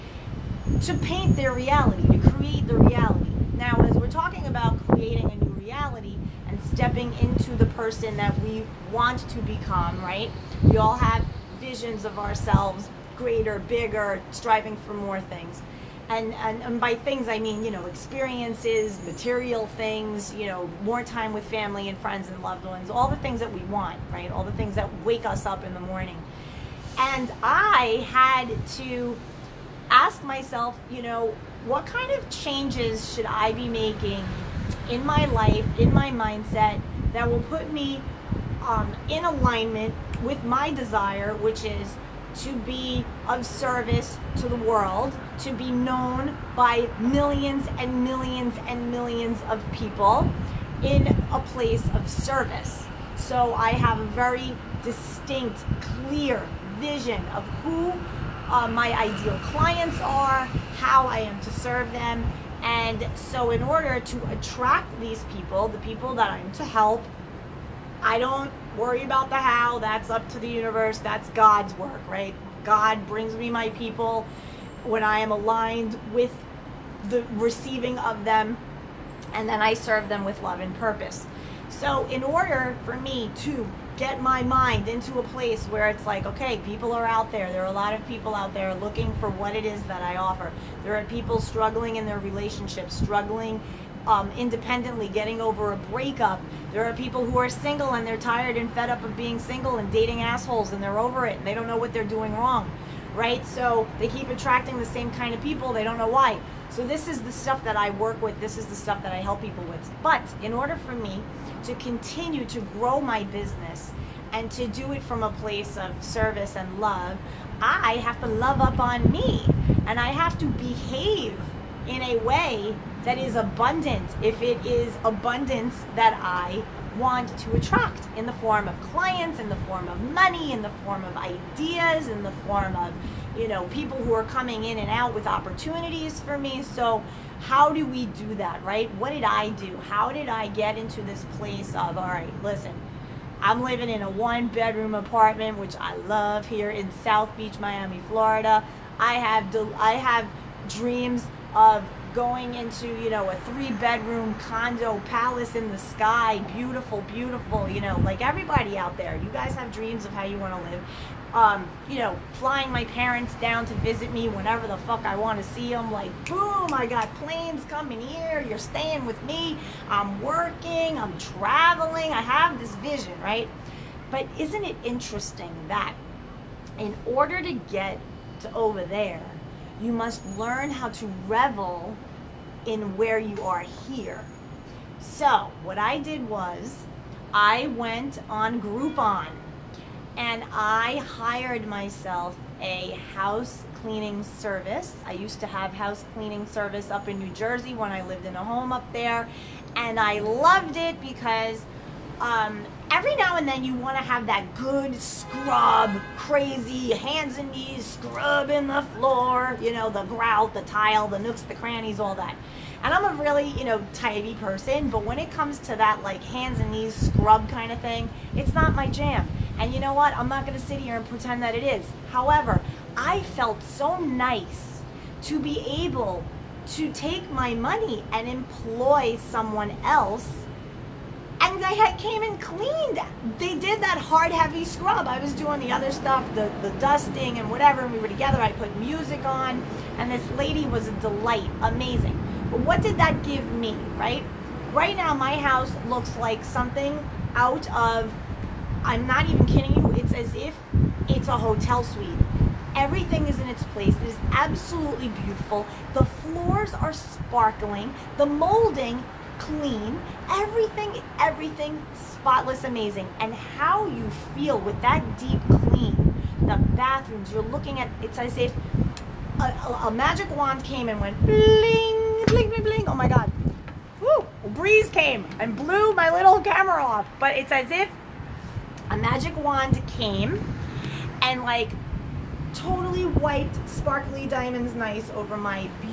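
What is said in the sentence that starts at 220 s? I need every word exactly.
I'm not going to sit here and pretend that it is.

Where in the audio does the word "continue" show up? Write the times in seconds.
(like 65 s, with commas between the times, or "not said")
111 s.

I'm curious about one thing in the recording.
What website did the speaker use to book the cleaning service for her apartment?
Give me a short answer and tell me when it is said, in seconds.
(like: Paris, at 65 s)
Groupon, at 188 s.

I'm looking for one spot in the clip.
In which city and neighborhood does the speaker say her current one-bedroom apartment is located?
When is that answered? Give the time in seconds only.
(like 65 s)
147 s.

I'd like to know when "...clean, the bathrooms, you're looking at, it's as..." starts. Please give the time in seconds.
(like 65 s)
265 s.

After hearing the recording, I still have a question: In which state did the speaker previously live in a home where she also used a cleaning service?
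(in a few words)
New Jersey.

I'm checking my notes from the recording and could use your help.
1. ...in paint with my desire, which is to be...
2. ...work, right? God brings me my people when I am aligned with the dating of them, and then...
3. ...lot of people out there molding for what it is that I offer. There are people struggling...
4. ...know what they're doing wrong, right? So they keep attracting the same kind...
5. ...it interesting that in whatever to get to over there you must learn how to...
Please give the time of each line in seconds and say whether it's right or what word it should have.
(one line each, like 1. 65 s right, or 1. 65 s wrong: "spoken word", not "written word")
1. 39 s wrong: "alignment", not "paint"
2. 71 s wrong: "receiving", not "dating"
3. 87 s wrong: "looking", not "molding"
4. 101 s right
5. 174 s wrong: "order", not "whatever".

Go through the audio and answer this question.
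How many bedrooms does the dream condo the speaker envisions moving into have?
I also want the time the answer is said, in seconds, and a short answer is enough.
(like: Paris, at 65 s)
3, at 153 s.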